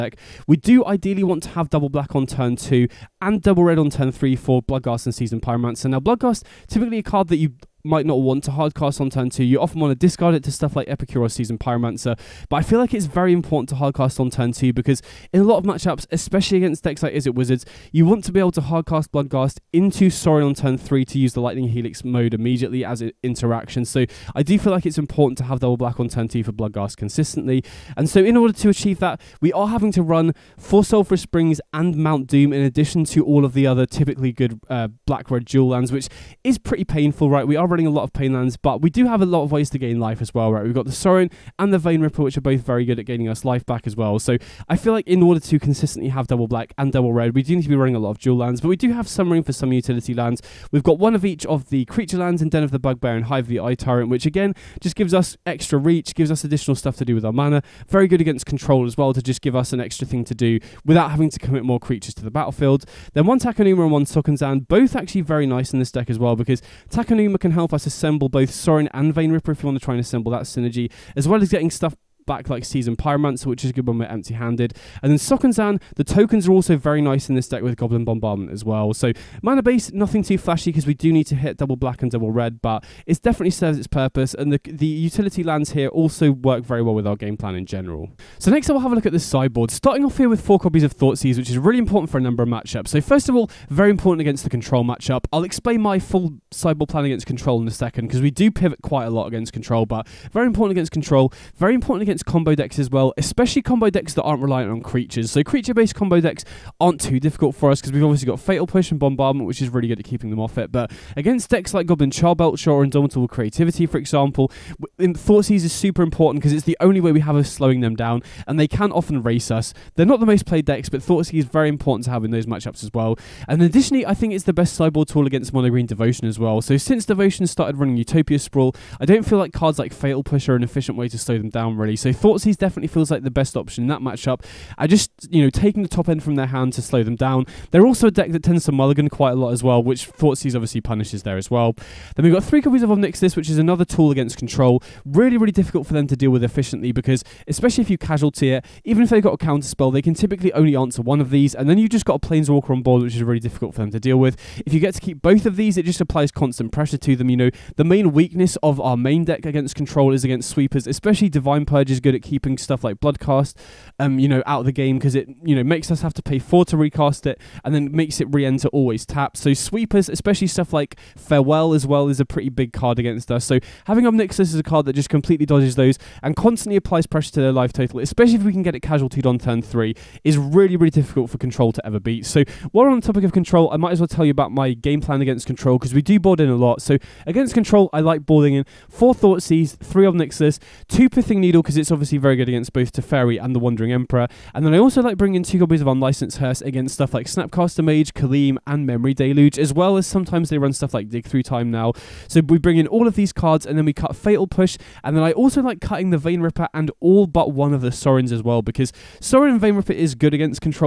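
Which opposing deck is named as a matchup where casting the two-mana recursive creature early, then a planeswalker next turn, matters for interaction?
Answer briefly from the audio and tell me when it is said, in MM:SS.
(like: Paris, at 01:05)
Izzet Wizards, at 00:17.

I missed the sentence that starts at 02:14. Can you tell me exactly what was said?
I just, you know, taking the top end from their hand to slow them down.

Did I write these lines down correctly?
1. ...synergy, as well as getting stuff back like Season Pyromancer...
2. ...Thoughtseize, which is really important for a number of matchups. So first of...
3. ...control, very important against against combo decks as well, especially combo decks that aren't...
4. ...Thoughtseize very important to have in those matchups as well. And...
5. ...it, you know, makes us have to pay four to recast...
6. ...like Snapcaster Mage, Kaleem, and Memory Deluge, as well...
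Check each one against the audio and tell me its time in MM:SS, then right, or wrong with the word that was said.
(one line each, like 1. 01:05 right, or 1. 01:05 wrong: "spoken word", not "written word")
1. 01:10 right
2. 01:30 right
3. 01:40 right
4. 02:01 right
5. 02:45 right
6. 03:17 right.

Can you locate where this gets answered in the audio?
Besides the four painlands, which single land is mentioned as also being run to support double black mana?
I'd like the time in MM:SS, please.
00:31.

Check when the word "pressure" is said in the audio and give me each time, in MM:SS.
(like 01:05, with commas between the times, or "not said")
02:36, 02:57.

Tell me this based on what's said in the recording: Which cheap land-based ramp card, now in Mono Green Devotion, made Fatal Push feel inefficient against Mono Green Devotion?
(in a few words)
Utopia Sprawl.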